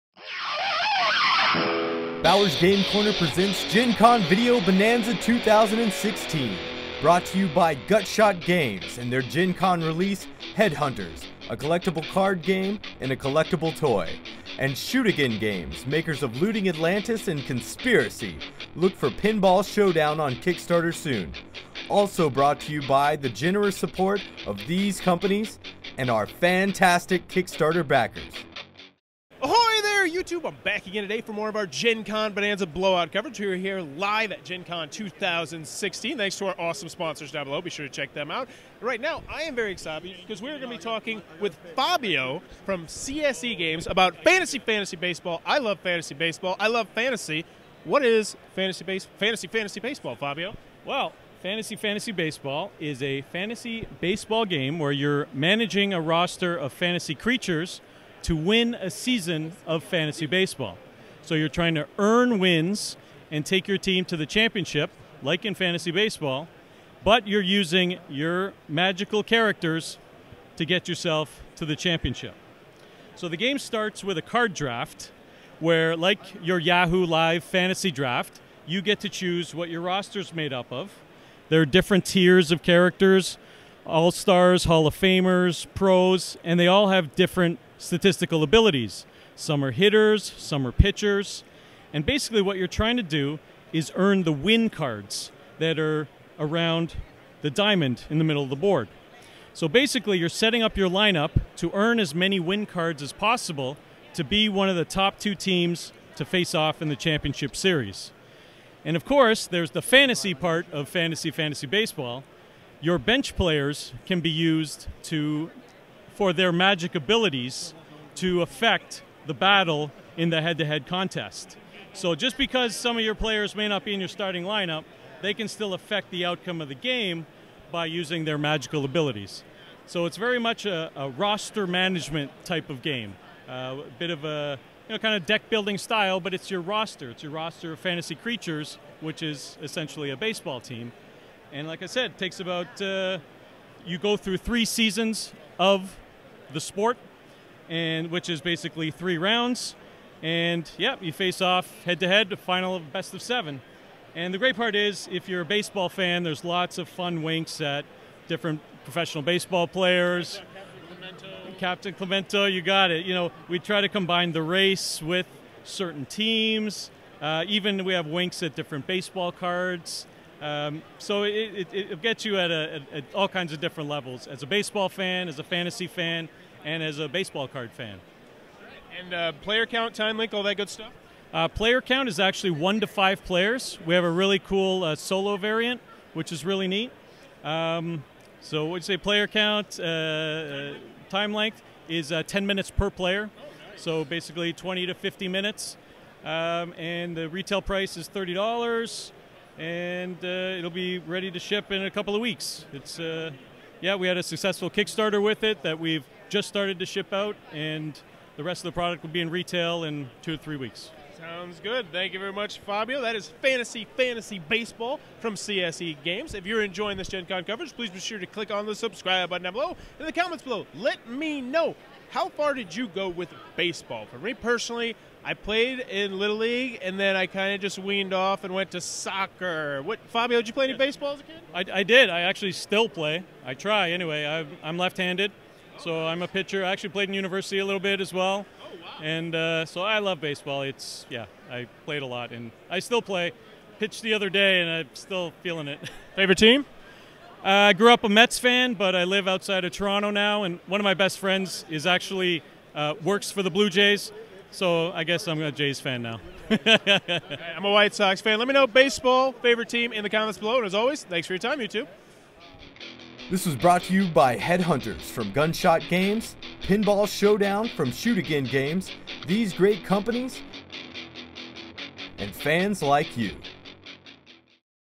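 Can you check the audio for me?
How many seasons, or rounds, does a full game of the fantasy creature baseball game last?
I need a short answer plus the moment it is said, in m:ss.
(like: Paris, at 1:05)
3, at 2:24.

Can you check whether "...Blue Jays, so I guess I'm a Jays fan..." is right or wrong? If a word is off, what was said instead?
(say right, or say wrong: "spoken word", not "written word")
right.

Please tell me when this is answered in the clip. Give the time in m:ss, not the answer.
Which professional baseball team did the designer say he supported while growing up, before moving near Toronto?
4:08.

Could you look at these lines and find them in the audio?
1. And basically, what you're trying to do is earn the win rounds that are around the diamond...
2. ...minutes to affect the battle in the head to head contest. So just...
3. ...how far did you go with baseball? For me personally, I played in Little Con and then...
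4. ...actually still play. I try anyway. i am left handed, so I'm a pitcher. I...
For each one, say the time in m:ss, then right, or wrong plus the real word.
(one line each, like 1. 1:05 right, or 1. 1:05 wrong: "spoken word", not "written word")
1. 1:31 wrong: "cards", not "rounds"
2. 1:56 wrong: "abilities", not "minutes"
3. 3:42 wrong: "League", not "Con"
4. 3:52 right.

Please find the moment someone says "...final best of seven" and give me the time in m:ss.
2:32.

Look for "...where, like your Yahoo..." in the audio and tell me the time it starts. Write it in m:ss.
1:15.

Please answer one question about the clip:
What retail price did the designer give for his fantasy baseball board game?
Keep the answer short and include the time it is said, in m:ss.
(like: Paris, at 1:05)
$30, at 3:18.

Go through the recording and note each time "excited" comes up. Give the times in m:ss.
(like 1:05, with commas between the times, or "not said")
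0:39.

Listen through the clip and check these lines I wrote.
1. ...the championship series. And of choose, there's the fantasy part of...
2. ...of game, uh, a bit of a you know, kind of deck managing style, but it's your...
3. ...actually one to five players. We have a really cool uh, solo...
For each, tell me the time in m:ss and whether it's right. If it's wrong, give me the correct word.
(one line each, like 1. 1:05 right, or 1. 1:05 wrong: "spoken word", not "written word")
1. 1:46 wrong: "course", not "choose"
2. 2:12 wrong: "building", not "managing"
3. 3:02 right.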